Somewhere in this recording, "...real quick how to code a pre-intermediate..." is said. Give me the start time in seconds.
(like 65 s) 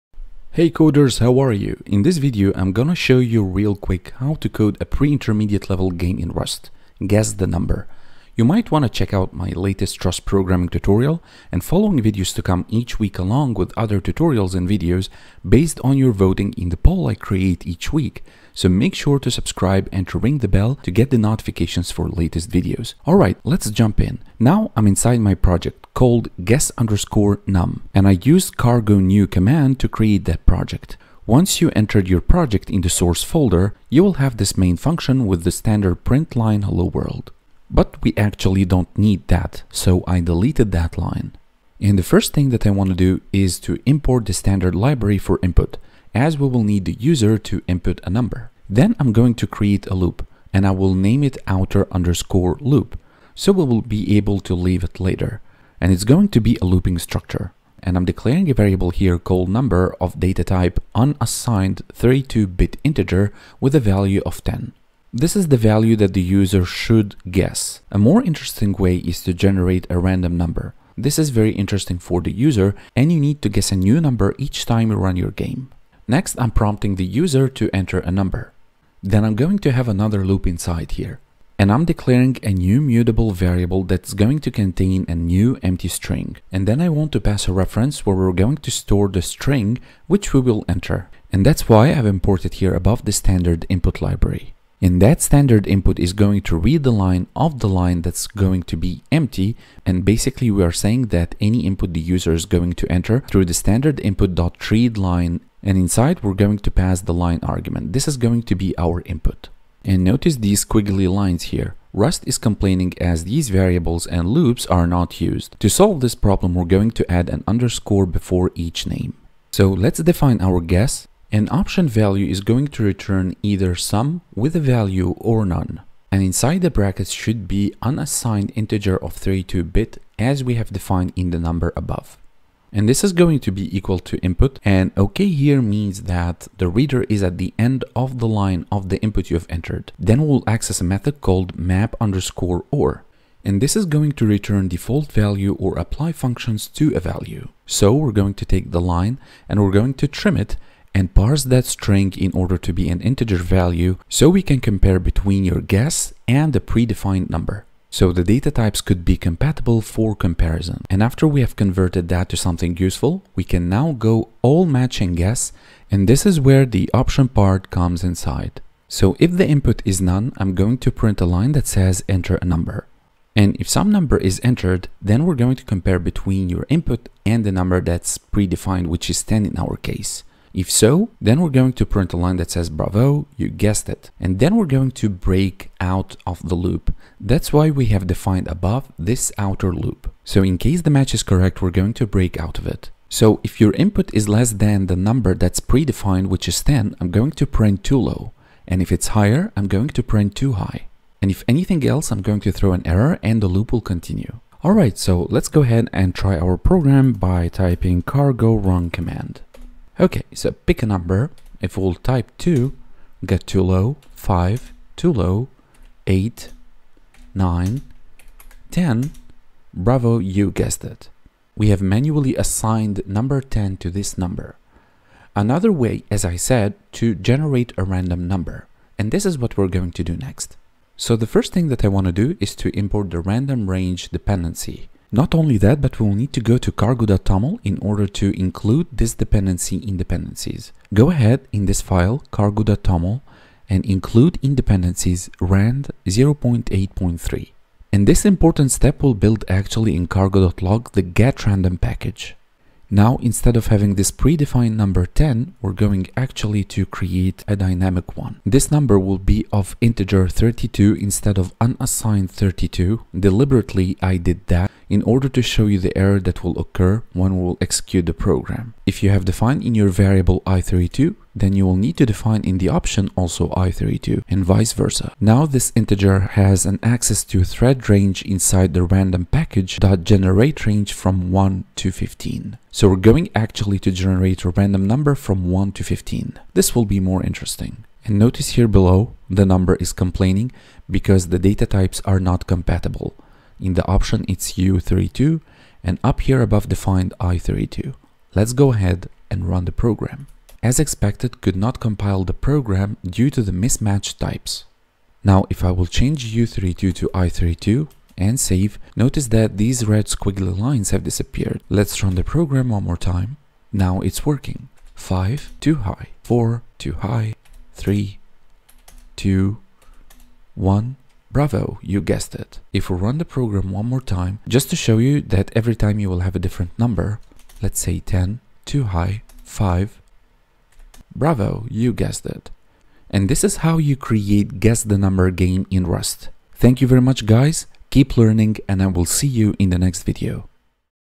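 3 s.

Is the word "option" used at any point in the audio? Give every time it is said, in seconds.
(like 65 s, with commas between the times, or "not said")
121 s, 166 s, 272 s, 293 s.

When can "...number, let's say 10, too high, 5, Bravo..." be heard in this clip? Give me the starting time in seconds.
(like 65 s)
326 s.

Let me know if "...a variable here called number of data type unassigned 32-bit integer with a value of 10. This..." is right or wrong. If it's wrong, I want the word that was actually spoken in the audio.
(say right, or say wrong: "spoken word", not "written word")
right.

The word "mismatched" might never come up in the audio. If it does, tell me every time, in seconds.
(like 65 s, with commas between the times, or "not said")
303 s.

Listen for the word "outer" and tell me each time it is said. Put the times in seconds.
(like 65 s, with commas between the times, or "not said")
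51 s, 189 s.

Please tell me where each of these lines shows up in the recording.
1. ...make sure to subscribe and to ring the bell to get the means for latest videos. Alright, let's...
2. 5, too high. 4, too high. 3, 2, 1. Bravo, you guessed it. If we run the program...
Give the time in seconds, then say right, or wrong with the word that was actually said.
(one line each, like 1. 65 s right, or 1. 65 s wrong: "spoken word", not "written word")
1. 18 s wrong: "notifications", not "means"
2. 314 s right.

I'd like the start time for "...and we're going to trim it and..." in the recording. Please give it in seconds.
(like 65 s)
149 s.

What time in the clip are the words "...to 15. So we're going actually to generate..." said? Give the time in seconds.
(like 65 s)
281 s.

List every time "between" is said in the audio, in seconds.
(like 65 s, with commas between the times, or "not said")
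154 s, 175 s.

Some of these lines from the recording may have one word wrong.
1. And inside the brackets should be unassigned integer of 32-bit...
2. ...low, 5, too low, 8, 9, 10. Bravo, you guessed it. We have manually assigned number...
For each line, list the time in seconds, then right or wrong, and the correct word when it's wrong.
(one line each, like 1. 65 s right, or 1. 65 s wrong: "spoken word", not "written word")
1. 126 s right
2. 213 s right.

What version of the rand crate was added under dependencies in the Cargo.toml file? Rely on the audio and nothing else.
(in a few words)
0.8.3.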